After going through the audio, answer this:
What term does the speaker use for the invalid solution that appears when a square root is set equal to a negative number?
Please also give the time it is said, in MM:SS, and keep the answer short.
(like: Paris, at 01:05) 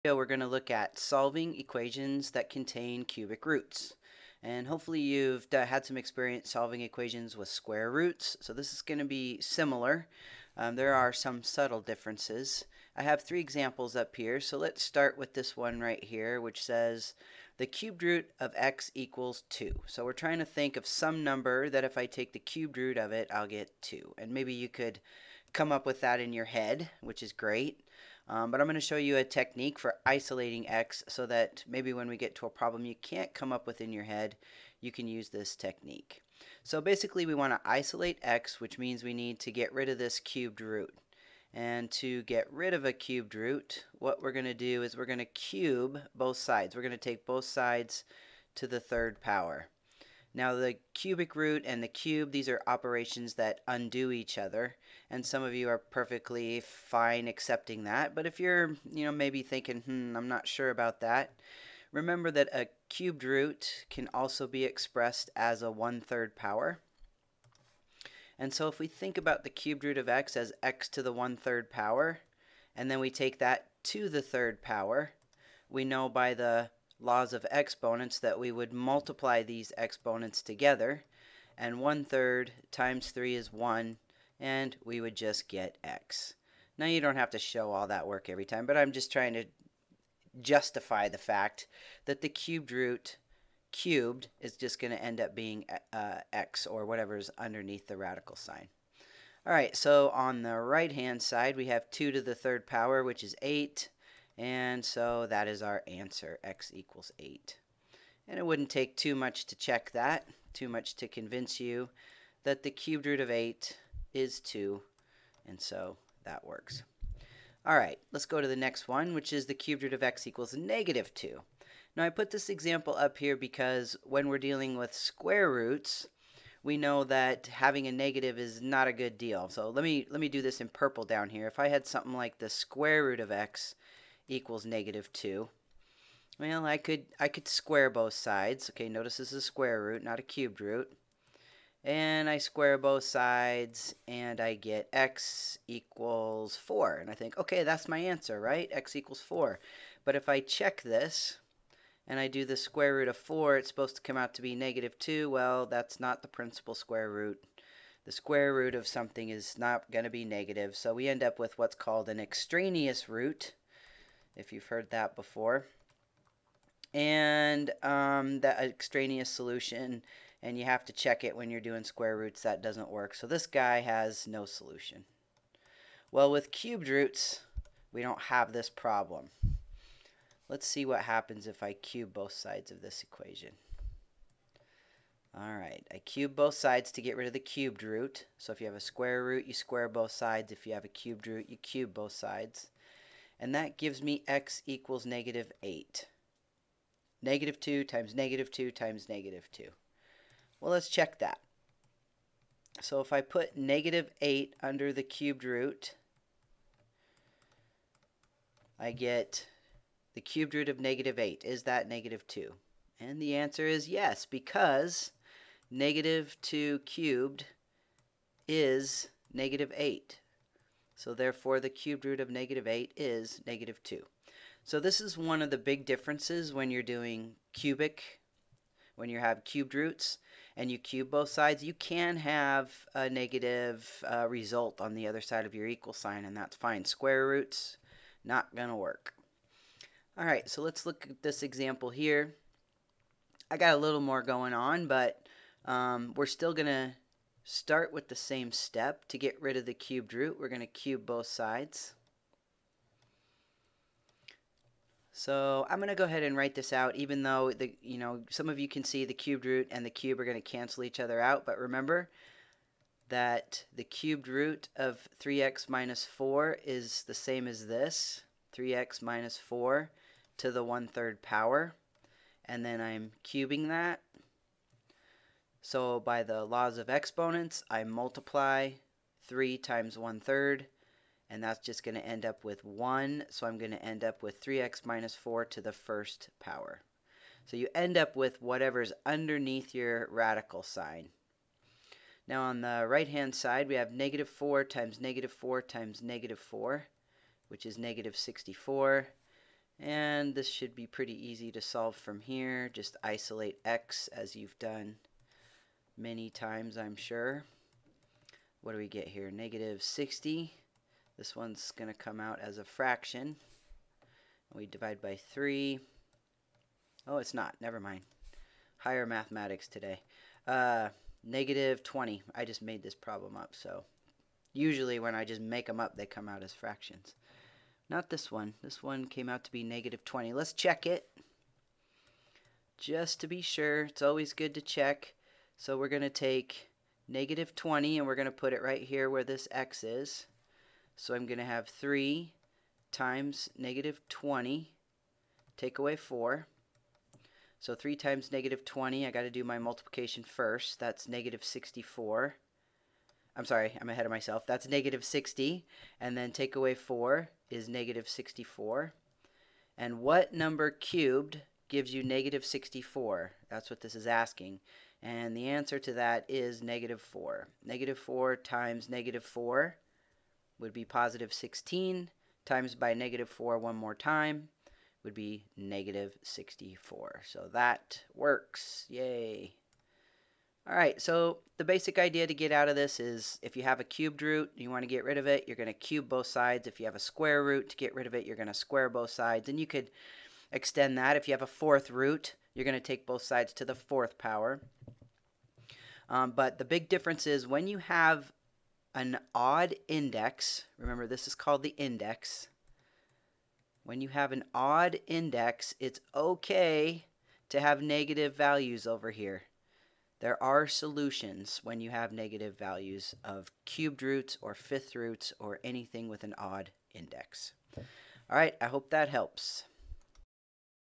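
extraneous root, at 02:42.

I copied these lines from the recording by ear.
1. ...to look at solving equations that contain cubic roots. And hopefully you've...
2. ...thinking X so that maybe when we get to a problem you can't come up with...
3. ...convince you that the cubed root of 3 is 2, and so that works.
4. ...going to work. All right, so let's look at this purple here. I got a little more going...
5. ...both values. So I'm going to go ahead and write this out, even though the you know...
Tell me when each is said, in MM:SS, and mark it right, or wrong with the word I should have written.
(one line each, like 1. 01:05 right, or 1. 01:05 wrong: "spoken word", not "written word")
1. 00:00 right
2. 00:30 wrong: "isolating", not "thinking"
3. 01:51 wrong: "8", not "3"
4. 03:58 wrong: "example", not "purple"
5. 04:11 wrong: "sides", not "values".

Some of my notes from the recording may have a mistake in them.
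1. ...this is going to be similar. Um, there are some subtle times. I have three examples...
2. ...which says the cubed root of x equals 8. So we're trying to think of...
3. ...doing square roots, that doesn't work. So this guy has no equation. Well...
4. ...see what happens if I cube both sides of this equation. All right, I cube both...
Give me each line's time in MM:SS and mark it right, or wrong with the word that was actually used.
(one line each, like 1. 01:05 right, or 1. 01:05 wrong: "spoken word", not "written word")
1. 00:08 wrong: "differences", not "times"
2. 00:16 wrong: "2", not "8"
3. 02:51 wrong: "solution", not "equation"
4. 03:00 right.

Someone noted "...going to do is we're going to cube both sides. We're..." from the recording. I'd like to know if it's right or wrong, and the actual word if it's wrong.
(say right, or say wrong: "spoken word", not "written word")
right.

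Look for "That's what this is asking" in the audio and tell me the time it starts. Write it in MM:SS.
06:03.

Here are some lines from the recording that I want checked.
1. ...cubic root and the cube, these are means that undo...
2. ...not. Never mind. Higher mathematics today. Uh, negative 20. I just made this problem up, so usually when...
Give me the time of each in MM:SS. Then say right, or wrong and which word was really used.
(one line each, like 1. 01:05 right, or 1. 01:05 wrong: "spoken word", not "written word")
1. 00:50 wrong: "operations", not "means"
2. 05:17 right.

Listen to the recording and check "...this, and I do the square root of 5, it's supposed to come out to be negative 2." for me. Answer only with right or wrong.
wrong.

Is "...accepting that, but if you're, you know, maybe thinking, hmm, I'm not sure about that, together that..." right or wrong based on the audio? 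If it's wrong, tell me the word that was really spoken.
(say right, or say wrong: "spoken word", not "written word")
wrong: "remember", not "together".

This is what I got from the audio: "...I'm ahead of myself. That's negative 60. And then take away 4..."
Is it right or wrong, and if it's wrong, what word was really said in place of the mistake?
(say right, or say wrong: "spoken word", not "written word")
right.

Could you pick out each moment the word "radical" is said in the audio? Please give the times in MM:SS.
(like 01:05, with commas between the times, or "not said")
01:37, 04:50.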